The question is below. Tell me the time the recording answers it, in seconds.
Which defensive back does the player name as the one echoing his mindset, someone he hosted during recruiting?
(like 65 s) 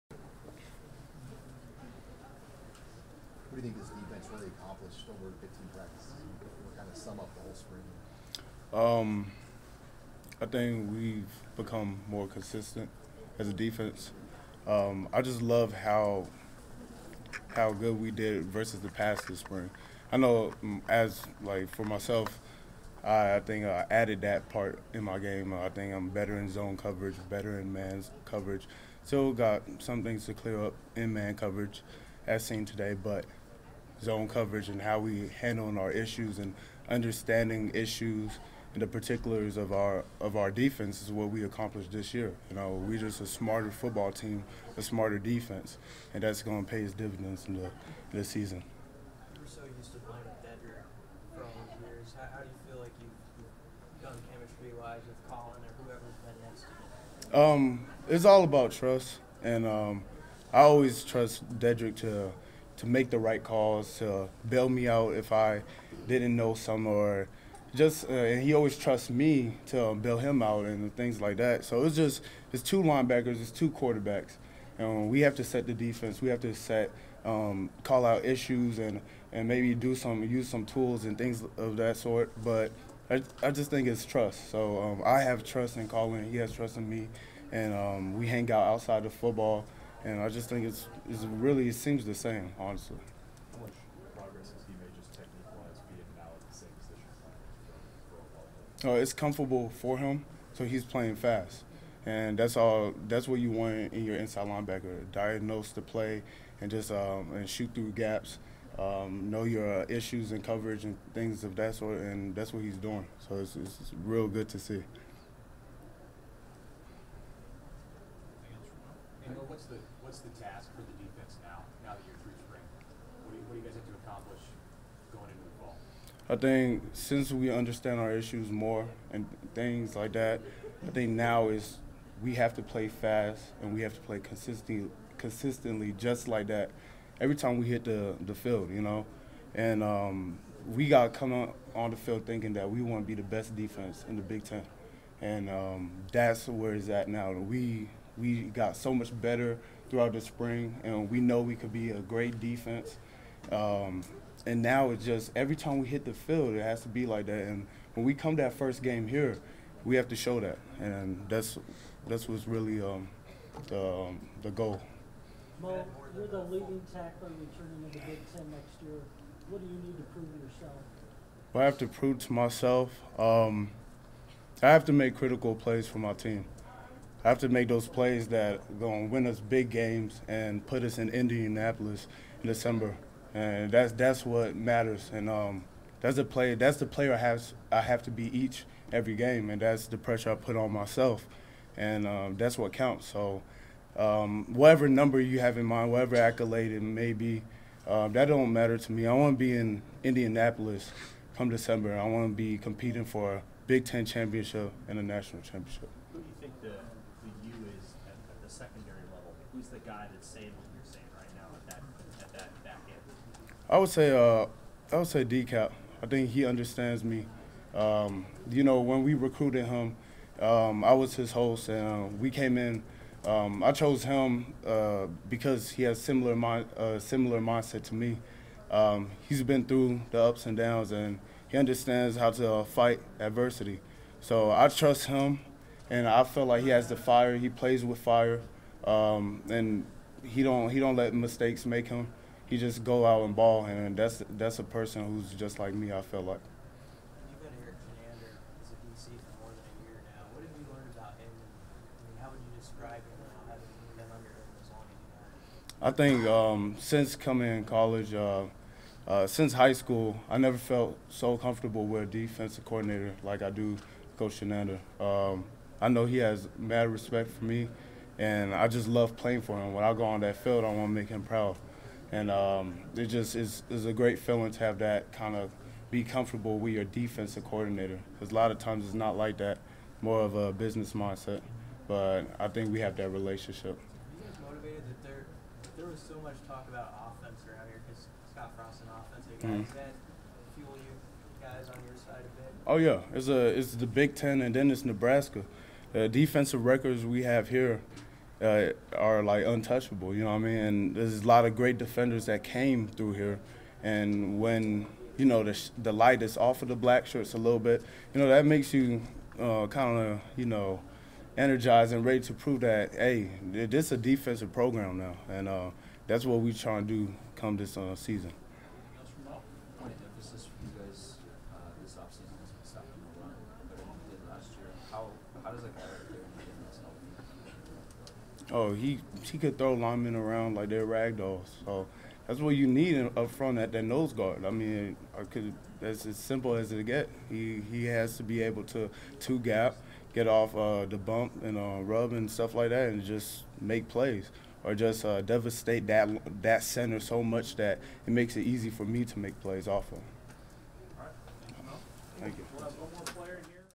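215 s.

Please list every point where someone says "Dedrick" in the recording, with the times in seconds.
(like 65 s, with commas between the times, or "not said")
50 s, 61 s.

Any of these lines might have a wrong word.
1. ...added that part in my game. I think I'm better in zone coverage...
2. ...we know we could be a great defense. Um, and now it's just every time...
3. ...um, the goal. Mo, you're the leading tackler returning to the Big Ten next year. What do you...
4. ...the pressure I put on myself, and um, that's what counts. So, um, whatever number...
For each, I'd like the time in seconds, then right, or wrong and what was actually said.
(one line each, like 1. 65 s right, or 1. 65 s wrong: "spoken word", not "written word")
1. 23 s right
2. 151 s right
3. 164 s right
4. 189 s right.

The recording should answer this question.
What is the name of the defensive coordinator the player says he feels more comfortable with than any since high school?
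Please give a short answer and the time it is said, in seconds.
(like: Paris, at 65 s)
Coach Chinander, at 264 s.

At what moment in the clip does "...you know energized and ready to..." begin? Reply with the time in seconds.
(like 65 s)
310 s.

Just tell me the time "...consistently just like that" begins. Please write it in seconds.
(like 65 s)
135 s.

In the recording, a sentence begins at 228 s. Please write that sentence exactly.
Um, he's been through the ups and downs, and he understands how to uh, fight adversity.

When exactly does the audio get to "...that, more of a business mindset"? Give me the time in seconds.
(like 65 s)
279 s.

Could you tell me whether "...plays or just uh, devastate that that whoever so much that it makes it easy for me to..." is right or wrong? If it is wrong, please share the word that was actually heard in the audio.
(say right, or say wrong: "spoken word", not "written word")
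wrong: "center", not "whoever".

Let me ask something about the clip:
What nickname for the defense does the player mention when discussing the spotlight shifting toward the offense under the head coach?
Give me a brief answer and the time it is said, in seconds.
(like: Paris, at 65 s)
Black shirts, at 306 s.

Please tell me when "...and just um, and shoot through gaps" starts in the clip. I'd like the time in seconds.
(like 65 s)
106 s.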